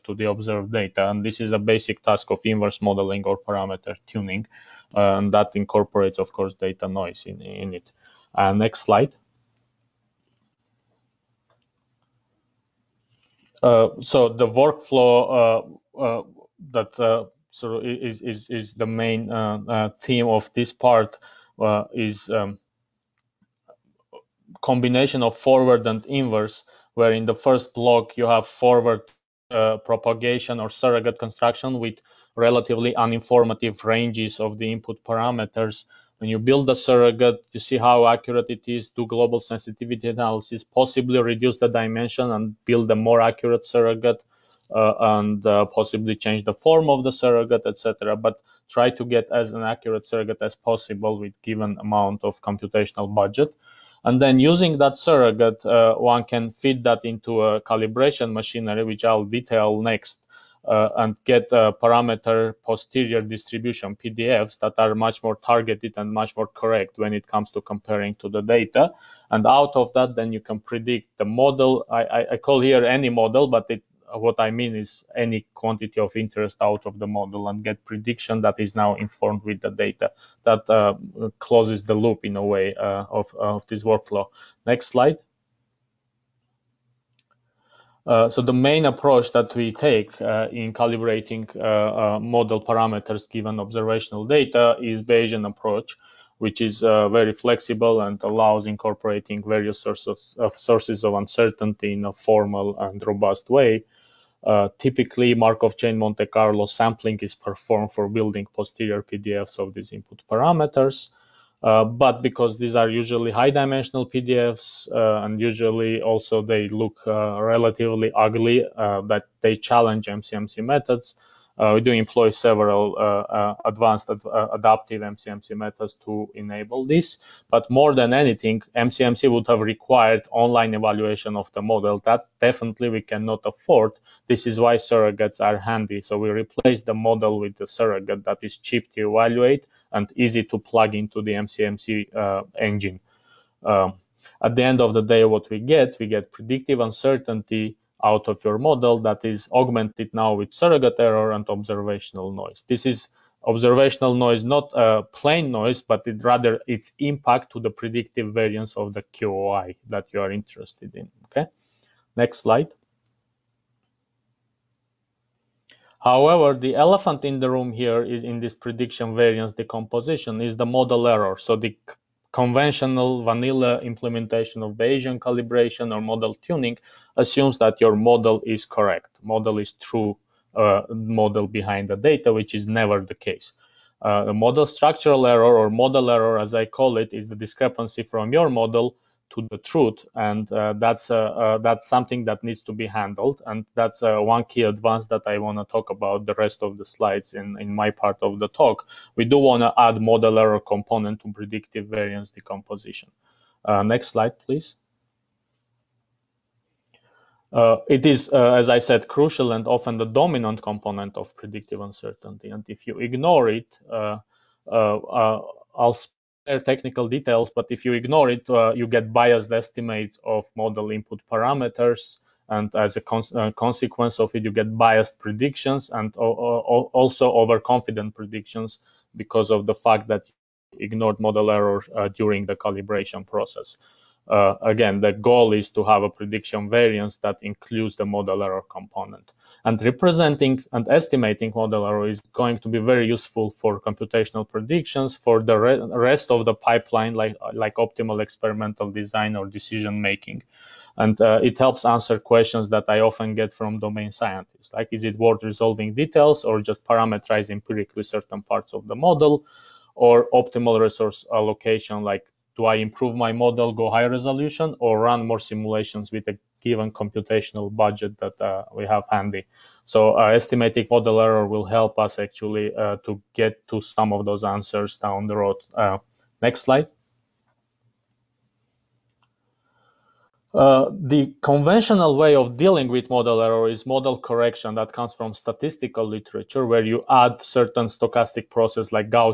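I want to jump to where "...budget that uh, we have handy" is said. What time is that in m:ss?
4:27.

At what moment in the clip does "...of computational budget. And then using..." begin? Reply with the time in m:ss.
0:52.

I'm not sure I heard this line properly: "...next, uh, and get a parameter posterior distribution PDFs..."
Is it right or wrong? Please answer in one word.
right.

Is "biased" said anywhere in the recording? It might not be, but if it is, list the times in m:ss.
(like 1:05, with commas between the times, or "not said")
3:39, 3:44.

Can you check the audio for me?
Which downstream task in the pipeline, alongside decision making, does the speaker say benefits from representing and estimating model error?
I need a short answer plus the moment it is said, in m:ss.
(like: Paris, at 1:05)
optimal experimental design, at 4:07.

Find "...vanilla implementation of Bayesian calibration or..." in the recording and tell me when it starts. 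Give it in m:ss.
2:53.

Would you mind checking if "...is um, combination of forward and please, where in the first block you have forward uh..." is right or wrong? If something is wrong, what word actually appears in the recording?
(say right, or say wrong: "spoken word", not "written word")
wrong: "inverse", not "please".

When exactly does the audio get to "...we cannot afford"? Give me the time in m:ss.
2:12.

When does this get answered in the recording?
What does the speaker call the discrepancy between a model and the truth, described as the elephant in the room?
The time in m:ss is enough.
3:04.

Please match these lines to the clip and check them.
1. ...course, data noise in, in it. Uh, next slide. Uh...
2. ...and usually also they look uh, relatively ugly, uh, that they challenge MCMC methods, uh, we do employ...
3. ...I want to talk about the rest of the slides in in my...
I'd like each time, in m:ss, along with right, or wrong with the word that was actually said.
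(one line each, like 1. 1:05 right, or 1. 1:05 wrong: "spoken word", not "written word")
1. 0:06 right
2. 1:55 right
3. 3:15 right.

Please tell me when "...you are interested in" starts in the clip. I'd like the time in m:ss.
2:40.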